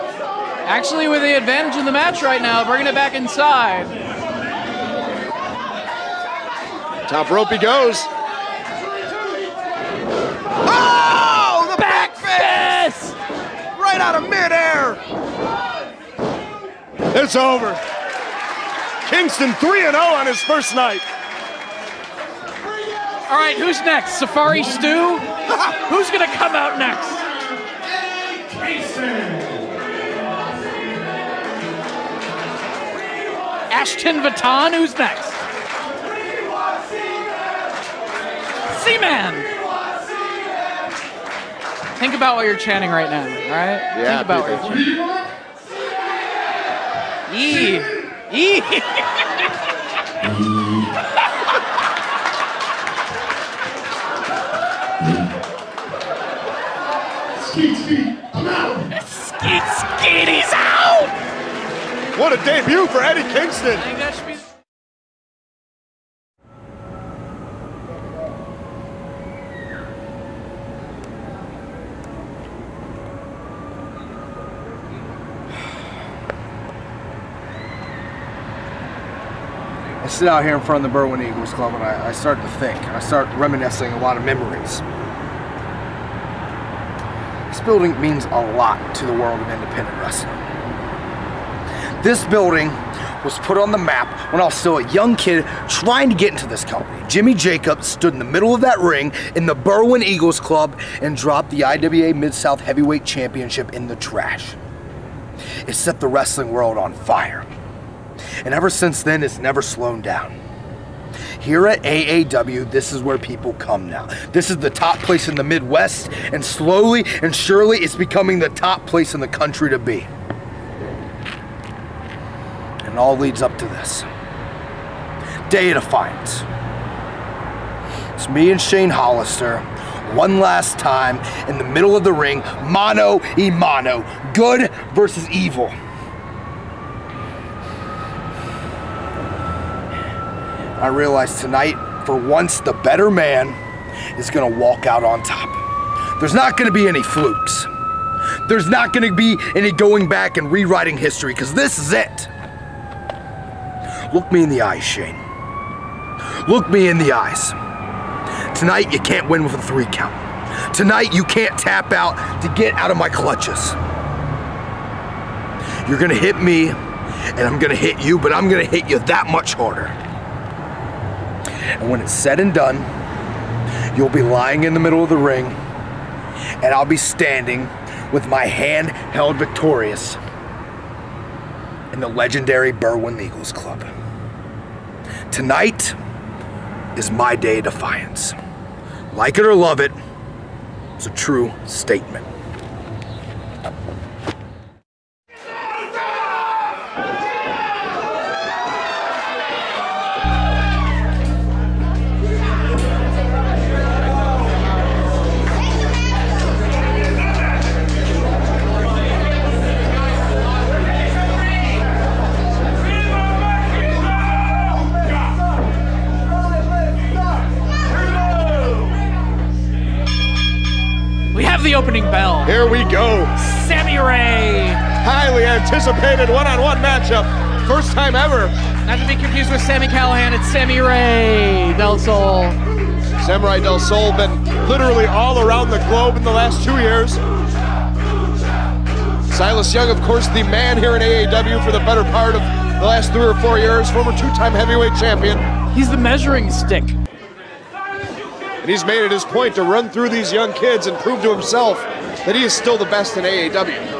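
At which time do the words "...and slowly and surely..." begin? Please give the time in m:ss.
1:56.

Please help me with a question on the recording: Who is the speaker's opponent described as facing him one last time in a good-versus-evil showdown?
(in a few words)
Shane Hollister.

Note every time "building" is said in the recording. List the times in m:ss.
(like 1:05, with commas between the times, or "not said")
1:27, 1:32.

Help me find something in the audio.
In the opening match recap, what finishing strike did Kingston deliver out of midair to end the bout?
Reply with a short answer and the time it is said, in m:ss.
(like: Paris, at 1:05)
Back fist, at 0:12.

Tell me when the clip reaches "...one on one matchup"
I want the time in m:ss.
3:46.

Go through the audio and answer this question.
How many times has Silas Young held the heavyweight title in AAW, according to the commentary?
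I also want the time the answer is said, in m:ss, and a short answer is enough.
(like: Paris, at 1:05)
2, at 4:04.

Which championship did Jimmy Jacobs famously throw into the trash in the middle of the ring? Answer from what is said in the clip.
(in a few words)
IWA Mid-South Heavyweight Championship.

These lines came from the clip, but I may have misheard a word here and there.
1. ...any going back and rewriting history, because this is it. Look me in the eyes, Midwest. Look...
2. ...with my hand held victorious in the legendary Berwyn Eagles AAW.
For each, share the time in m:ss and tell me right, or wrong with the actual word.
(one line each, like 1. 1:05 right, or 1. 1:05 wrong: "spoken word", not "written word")
1. 2:29 wrong: "Shane", not "Midwest"
2. 2:58 wrong: "Club", not "AAW".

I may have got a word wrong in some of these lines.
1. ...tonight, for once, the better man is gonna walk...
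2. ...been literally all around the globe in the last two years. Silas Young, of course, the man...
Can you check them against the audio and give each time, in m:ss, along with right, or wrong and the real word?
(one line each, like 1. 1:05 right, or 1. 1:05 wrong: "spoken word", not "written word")
1. 2:21 right
2. 3:54 right.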